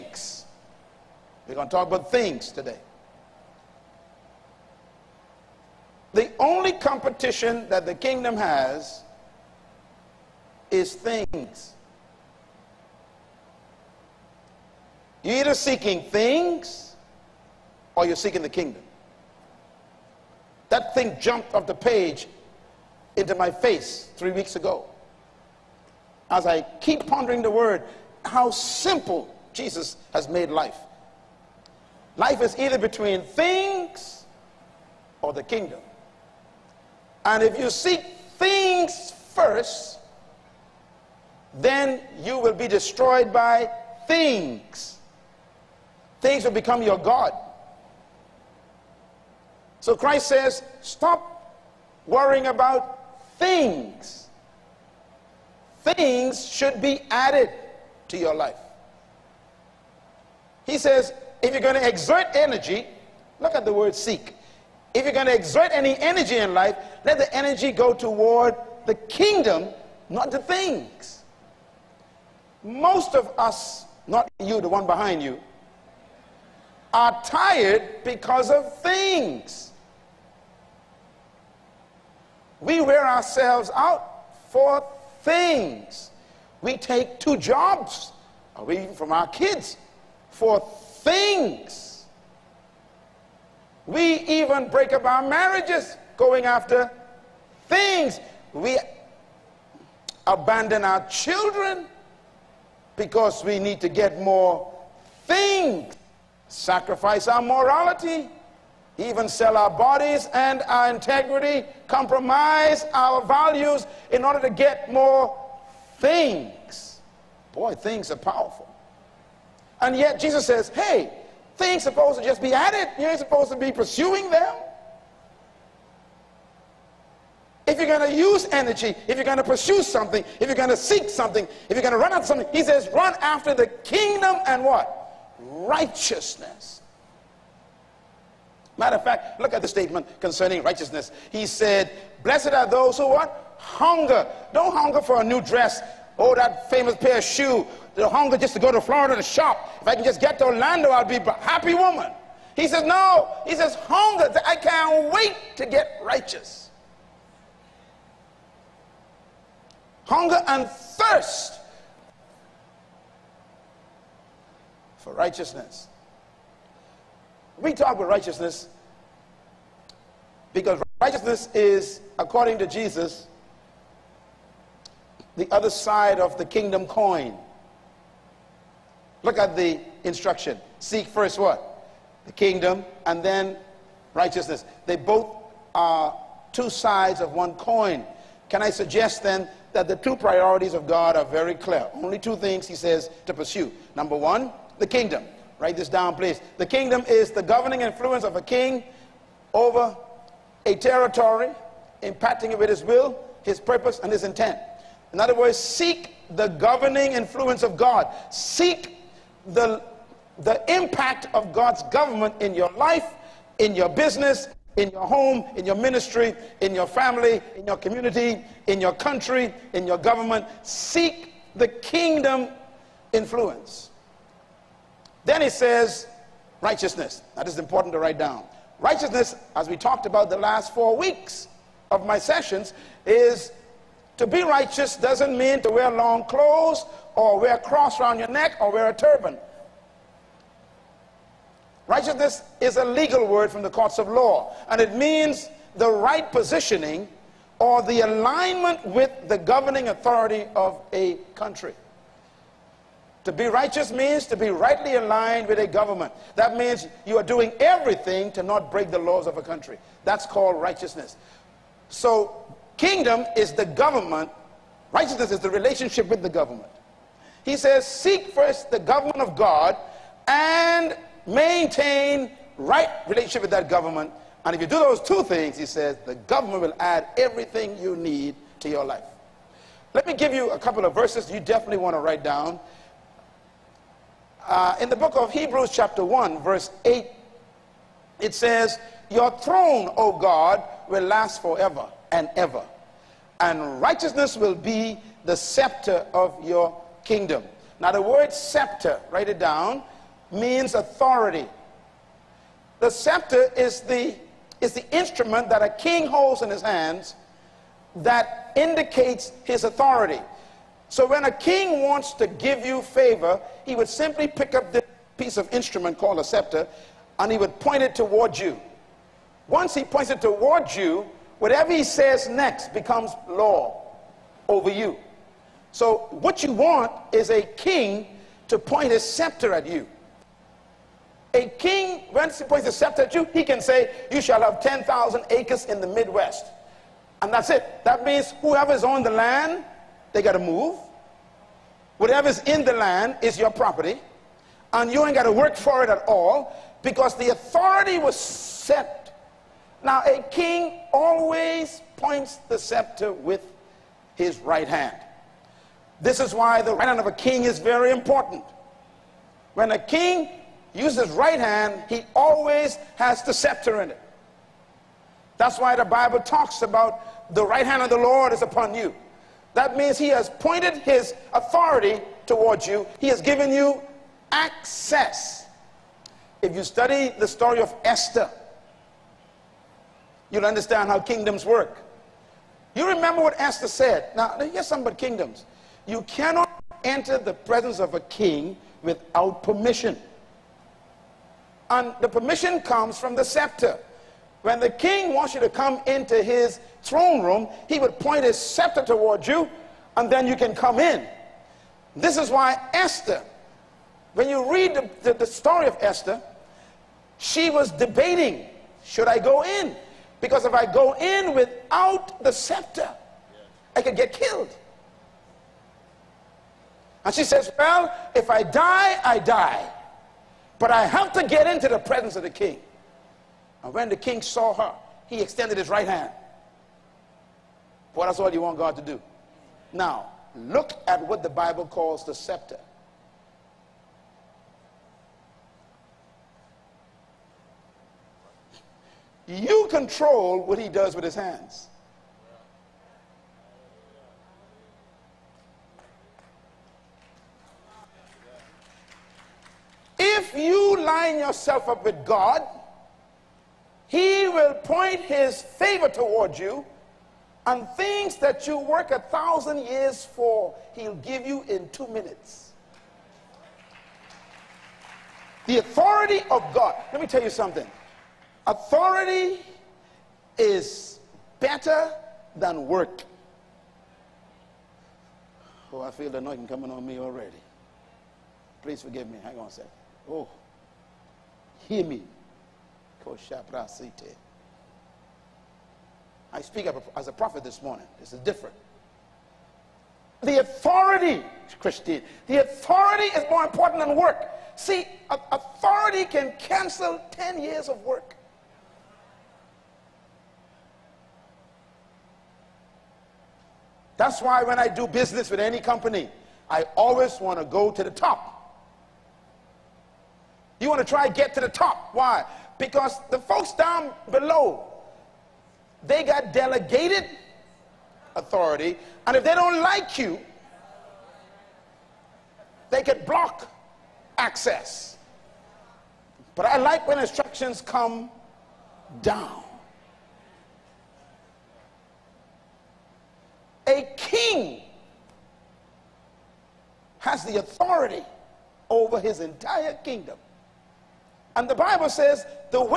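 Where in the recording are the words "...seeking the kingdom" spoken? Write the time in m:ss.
0:18.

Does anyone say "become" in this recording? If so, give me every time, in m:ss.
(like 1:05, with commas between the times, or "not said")
0:46, 5:22.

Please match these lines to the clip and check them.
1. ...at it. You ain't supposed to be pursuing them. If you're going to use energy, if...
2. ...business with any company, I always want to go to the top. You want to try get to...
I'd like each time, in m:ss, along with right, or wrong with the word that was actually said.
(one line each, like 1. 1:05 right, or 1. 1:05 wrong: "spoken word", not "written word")
1. 2:02 right
2. 8:24 right.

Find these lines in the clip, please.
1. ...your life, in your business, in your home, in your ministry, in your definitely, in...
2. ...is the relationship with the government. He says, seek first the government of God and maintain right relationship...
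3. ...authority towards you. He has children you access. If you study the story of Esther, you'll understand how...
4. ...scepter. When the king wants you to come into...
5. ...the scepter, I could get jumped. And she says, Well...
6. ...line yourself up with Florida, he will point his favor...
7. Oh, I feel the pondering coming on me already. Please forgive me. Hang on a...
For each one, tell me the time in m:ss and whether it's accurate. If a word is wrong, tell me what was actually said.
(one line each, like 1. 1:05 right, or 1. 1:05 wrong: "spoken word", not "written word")
1. 3:32 wrong: "family", not "definitely"
2. 4:25 right
3. 6:11 wrong: "given", not "children"
4. 6:33 right
5. 6:52 wrong: "killed", not "jumped"
6. 7:30 wrong: "God", not "Florida"
7. 7:55 wrong: "anointing", not "pondering".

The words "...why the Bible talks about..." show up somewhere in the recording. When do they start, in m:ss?
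6:05.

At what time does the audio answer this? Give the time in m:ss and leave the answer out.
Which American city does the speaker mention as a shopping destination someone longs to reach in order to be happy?
2:30.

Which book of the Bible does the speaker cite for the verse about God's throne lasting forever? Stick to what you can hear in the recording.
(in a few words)
Hebrews.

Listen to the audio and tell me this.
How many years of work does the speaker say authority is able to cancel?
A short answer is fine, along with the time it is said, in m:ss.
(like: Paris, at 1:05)
10, at 8:17.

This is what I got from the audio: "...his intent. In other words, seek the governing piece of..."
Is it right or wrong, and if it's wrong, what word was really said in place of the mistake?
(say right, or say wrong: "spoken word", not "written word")
wrong: "influence", not "piece".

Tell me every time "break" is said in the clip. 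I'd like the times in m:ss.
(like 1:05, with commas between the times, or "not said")
1:34, 4:18.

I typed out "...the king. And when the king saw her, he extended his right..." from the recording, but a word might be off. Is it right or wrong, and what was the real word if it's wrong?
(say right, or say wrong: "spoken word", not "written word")
right.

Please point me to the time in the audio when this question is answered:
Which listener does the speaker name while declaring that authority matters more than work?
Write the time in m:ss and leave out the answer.
8:11.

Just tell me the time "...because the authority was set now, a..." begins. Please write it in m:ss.
5:46.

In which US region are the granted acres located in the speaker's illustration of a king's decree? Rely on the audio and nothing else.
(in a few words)
Midwest.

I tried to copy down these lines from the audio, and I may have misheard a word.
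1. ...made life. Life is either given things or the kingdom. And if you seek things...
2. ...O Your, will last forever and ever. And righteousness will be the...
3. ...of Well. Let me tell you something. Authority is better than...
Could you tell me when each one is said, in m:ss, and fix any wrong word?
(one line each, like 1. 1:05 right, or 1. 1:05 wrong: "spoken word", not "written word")
1. 0:30 wrong: "between", not "given"
2. 4:49 wrong: "God", not "Your"
3. 7:46 wrong: "God", not "Well".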